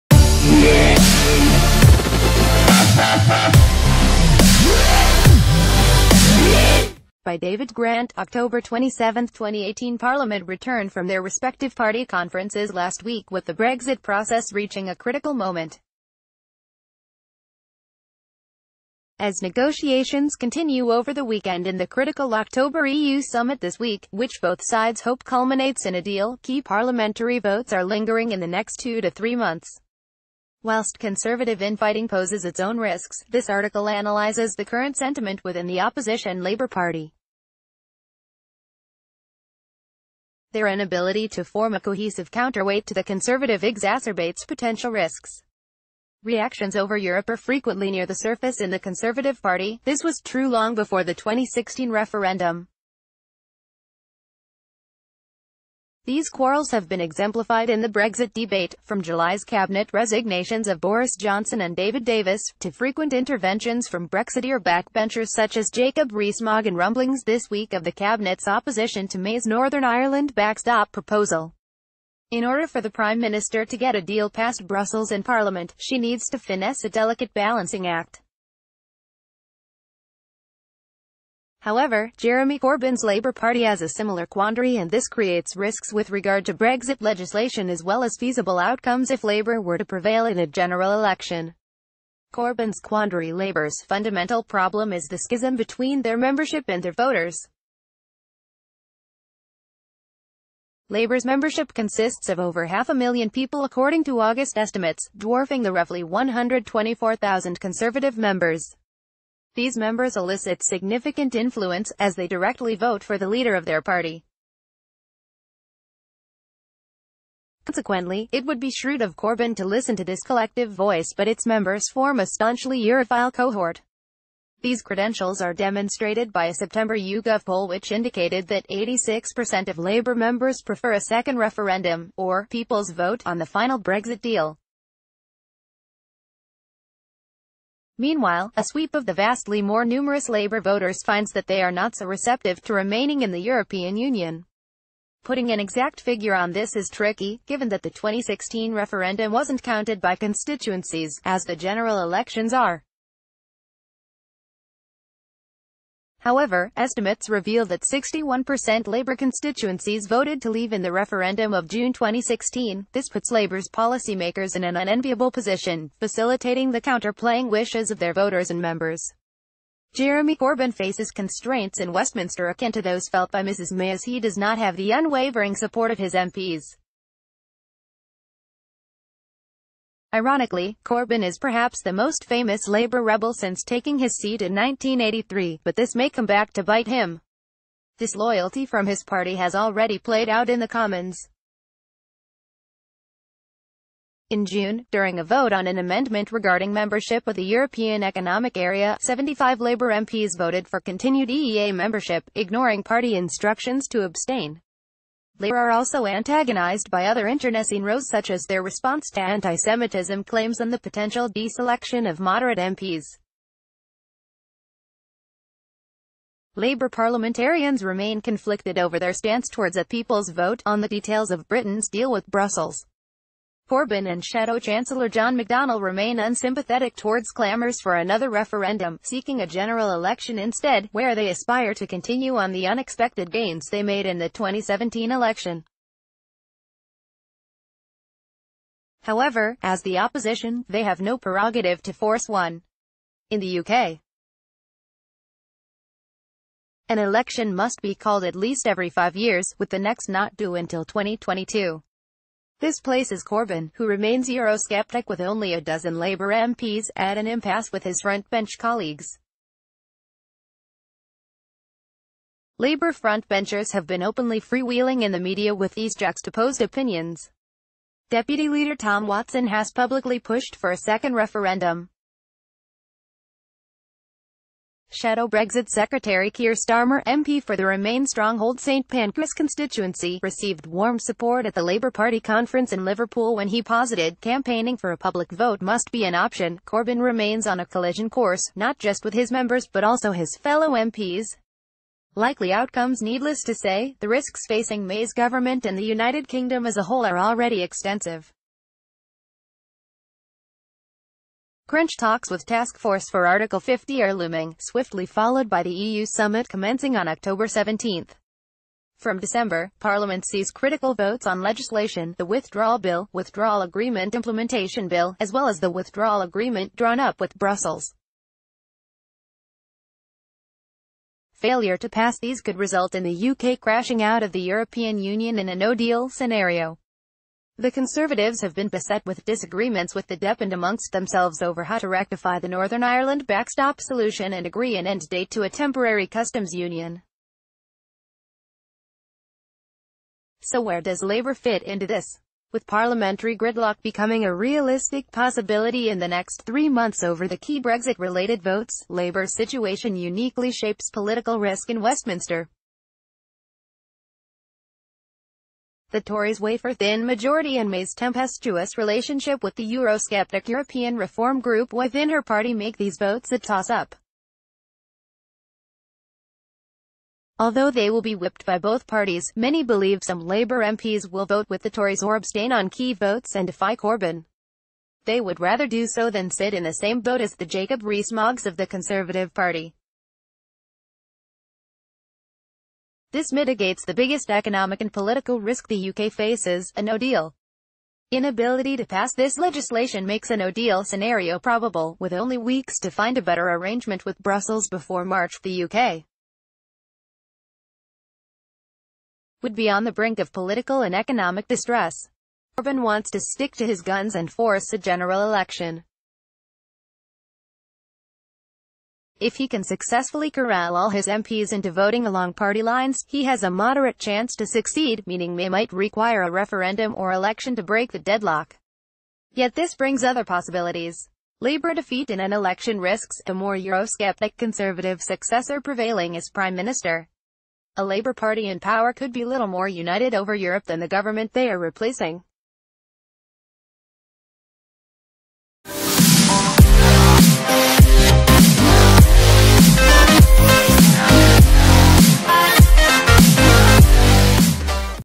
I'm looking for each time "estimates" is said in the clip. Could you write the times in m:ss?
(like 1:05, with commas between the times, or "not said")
1:44, 2:36.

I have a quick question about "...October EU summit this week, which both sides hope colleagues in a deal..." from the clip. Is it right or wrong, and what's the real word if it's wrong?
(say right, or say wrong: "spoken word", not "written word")
wrong: "culminates", not "colleagues".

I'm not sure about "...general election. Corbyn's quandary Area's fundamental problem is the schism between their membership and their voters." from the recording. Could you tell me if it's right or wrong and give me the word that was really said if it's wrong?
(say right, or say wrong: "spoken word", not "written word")
wrong: "Labour", not "Area".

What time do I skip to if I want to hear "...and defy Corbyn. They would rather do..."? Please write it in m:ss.
6:13.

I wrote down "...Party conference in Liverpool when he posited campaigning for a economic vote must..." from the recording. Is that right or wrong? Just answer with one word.
wrong.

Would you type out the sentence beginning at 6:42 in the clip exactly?
Corbyn wants to stick to his guns and force a general election.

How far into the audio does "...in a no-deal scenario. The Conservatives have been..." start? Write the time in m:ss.
5:25.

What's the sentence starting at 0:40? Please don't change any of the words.
Their inability to form a cohesive counterweight to the conservative exacerbates potential risks.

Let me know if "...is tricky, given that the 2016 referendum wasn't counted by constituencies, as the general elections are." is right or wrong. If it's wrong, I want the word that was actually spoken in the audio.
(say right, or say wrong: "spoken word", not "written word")
right.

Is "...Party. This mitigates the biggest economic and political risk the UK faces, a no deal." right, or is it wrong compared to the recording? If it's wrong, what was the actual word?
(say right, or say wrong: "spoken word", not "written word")
right.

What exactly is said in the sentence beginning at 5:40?
So where does Labour fit into this?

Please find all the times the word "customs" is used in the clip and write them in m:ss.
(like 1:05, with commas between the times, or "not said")
5:36.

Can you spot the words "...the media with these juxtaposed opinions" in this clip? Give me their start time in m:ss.
4:25.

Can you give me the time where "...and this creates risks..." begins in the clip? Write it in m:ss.
1:24.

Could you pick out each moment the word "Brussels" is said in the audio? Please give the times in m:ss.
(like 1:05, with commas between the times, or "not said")
1:14, 3:42, 5:17, 6:34.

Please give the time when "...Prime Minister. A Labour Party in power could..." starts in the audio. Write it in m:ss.
7:06.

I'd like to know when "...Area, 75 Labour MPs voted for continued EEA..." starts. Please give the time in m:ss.
3:18.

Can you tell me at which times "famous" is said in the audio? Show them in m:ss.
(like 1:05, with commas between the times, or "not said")
3:02.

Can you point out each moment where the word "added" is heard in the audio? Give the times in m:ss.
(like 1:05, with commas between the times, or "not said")
not said.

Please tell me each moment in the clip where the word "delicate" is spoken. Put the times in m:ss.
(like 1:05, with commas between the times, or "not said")
1:16.